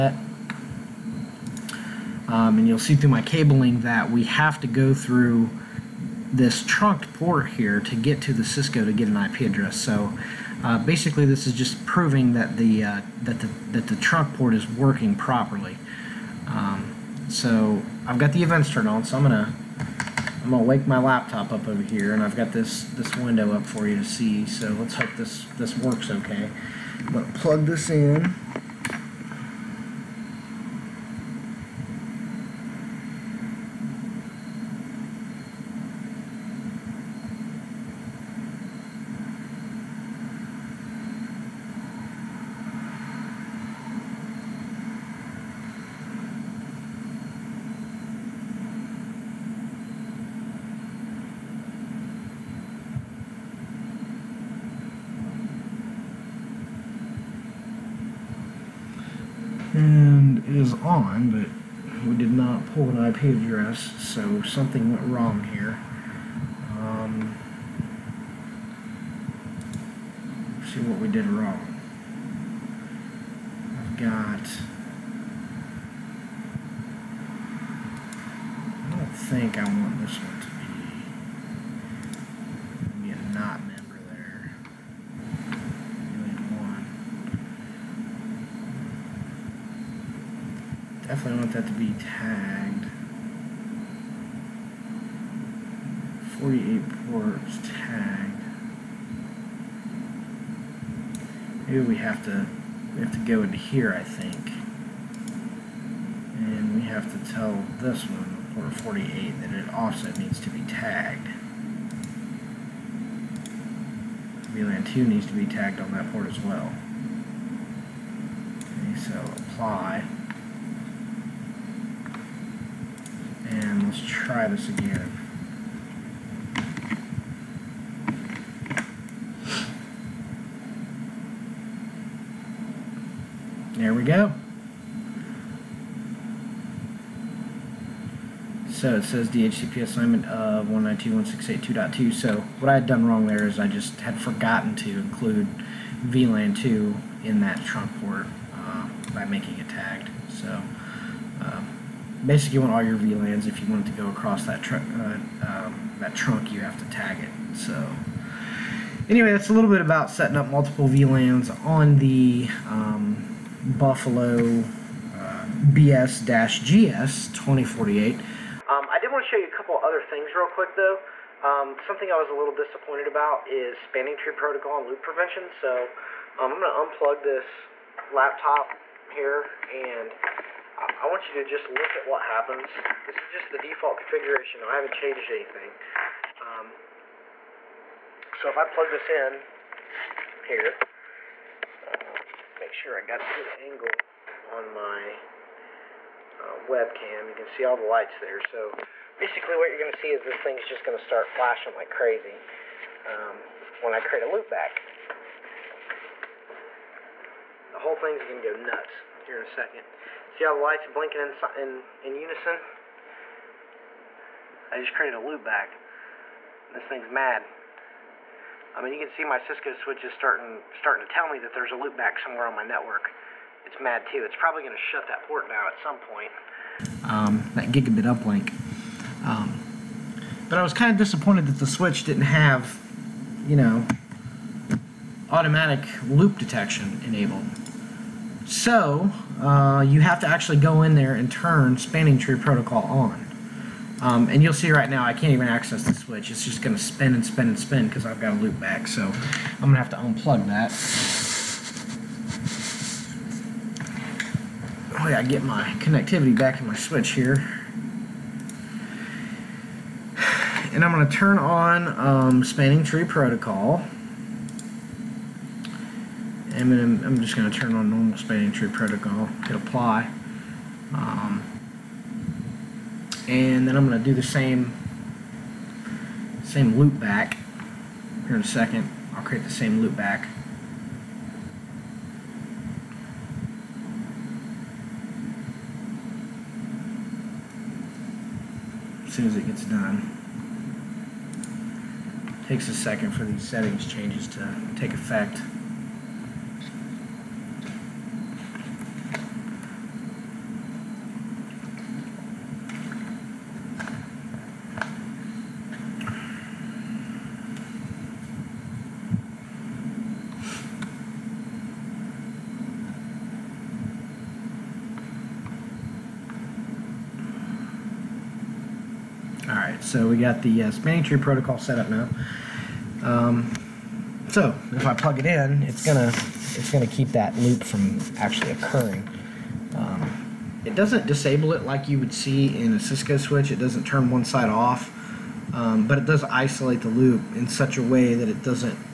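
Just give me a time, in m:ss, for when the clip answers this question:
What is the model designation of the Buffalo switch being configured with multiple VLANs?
2:45.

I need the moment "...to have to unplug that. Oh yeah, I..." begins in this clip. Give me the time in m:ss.
4:09.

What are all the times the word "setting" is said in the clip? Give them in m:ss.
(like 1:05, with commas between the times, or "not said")
2:40, 4:53.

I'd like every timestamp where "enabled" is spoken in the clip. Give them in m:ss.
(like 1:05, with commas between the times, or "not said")
3:57.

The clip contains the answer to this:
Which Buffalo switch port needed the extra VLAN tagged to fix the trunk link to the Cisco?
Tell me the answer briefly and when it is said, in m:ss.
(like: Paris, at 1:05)
48, at 1:48.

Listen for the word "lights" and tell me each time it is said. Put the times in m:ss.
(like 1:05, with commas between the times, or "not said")
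3:17, 3:30.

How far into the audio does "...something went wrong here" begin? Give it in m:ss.
1:04.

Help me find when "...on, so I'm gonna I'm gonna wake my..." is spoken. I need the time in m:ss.
0:18.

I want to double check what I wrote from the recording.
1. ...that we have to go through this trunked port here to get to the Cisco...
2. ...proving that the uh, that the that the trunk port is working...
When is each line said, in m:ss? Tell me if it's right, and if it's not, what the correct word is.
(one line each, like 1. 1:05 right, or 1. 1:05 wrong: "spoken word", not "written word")
1. 0:03 right
2. 0:11 right.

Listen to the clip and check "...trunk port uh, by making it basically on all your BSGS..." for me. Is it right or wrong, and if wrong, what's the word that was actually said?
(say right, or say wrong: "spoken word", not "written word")
wrong: "VLANs", not "BSGS".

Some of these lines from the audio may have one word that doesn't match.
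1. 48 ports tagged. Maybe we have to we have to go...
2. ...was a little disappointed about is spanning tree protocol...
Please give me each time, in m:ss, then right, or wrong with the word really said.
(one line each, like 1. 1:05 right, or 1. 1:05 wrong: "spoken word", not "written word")
1. 1:36 right
2. 2:52 right.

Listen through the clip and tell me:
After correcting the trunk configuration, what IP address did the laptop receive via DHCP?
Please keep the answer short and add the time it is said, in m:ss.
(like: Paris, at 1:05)
192.168.2.2, at 2:20.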